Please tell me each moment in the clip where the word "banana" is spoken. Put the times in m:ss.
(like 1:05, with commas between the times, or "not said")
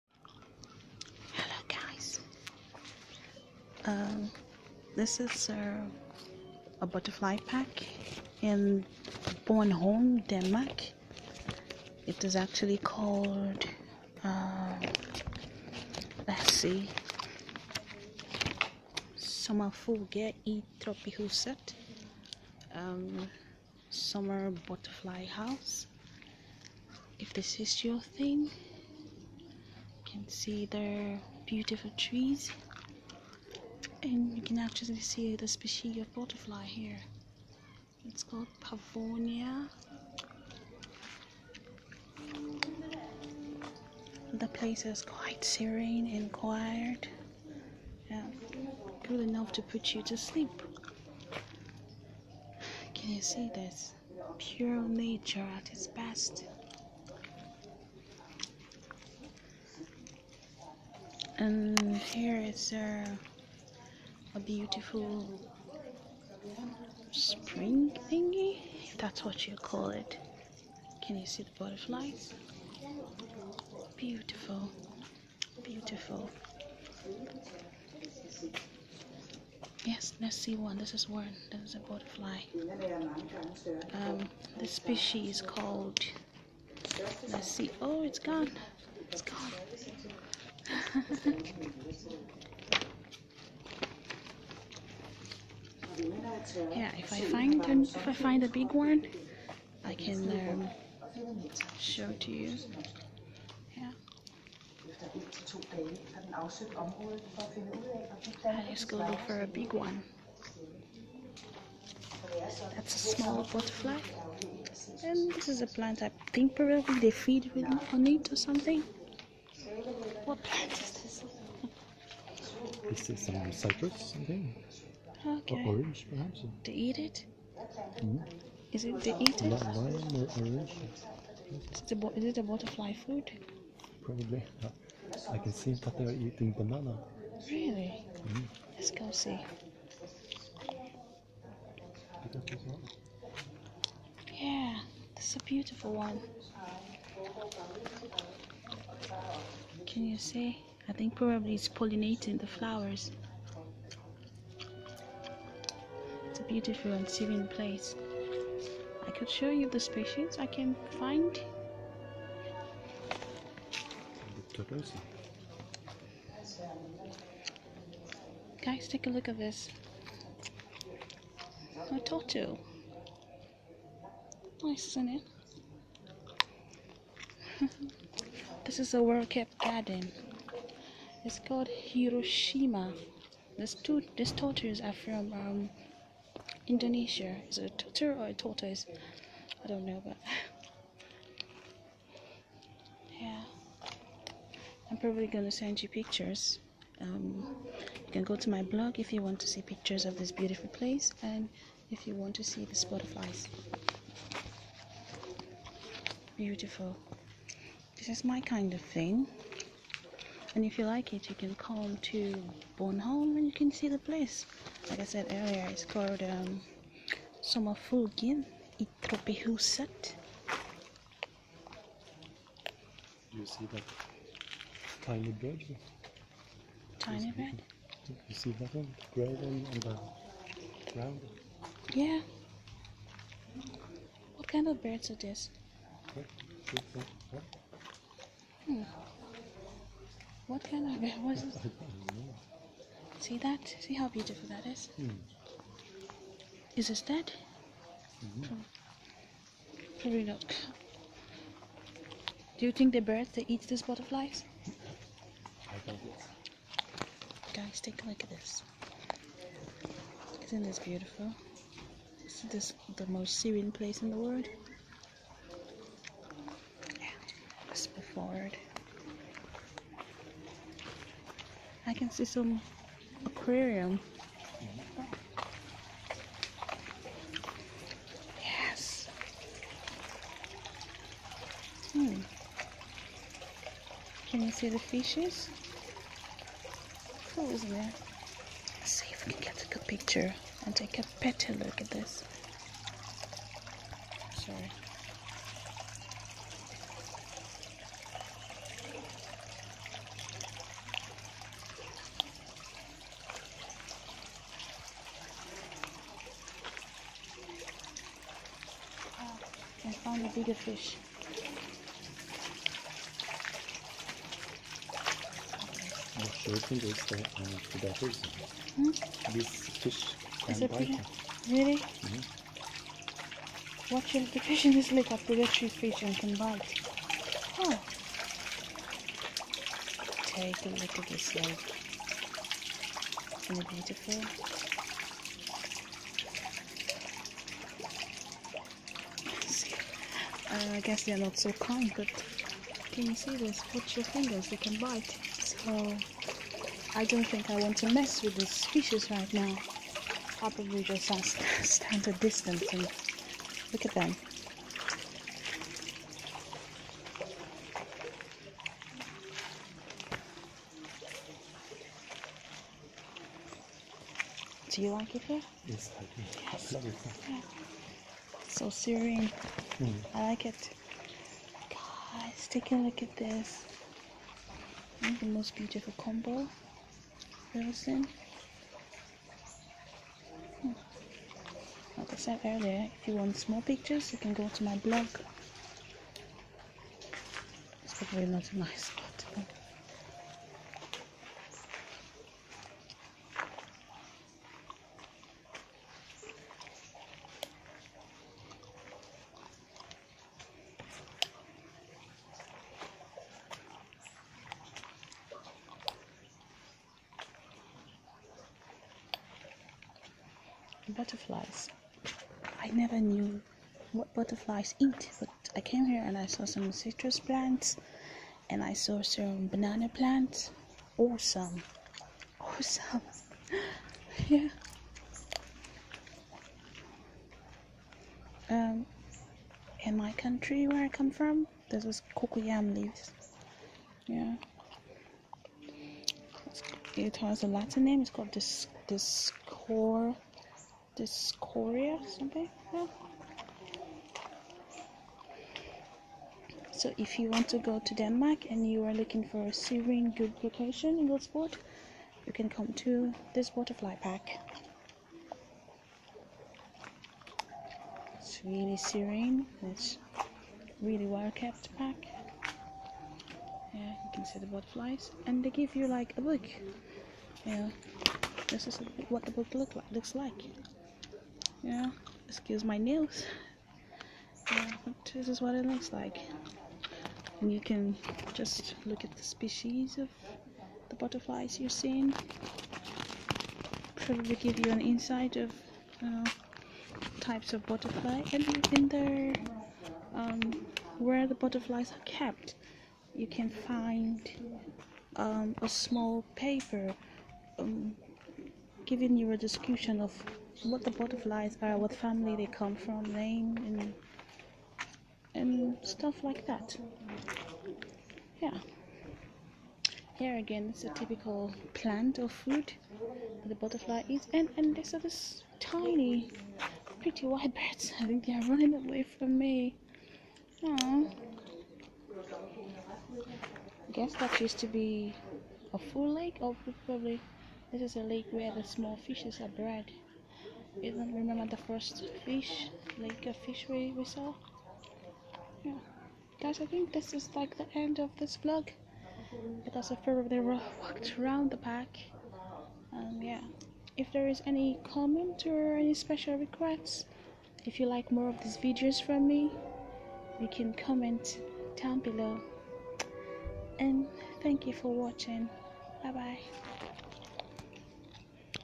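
2:16, 6:59.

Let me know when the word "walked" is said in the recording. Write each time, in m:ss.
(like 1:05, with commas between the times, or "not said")
9:00.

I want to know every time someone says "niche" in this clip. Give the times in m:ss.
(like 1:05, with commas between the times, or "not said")
not said.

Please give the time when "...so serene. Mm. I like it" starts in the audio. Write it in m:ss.
6:08.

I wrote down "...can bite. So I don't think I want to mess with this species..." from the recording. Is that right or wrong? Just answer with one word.
right.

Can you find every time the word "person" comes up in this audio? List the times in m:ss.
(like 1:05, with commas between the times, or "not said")
5:17.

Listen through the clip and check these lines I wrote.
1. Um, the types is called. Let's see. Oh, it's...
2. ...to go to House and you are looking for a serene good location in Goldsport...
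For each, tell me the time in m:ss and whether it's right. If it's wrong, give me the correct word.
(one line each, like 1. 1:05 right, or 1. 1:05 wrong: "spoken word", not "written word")
1. 1:24 wrong: "species", not "types"
2. 7:27 wrong: "Denmark", not "House".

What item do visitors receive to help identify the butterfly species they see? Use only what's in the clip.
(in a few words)
a book.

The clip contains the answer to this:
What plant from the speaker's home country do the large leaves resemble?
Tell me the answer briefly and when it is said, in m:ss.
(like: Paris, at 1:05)
cocoyam, at 7:12.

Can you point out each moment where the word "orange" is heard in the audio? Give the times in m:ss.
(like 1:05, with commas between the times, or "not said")
2:05, 2:09.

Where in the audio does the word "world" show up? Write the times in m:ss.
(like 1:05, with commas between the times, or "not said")
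2:59, 4:24.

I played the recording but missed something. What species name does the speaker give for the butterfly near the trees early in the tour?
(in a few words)
pavonia.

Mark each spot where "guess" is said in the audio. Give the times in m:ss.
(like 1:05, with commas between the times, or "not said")
5:40, 8:43.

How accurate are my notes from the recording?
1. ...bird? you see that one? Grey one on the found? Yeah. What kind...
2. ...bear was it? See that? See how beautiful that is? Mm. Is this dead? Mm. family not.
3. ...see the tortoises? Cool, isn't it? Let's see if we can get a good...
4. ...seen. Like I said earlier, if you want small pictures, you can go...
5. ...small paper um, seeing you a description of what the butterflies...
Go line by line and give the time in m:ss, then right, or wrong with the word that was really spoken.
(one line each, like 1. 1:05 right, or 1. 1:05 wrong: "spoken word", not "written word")
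1. 3:47 wrong: "ground", not "found"
2. 4:01 wrong: "probably", not "family"
3. 4:44 wrong: "fishes", not "tortoises"
4. 6:17 right
5. 8:15 wrong: "giving", not "seeing".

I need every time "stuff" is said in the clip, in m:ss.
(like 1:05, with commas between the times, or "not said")
8:25.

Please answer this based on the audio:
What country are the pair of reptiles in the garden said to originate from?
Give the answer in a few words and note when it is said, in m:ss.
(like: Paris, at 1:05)
Indonesia, at 3:06.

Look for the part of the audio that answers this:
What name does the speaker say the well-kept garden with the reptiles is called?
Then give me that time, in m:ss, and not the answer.
3:01.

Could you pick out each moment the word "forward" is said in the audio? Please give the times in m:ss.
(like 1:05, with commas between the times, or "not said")
4:28.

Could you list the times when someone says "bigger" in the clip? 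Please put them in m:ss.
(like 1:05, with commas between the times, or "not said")
5:10.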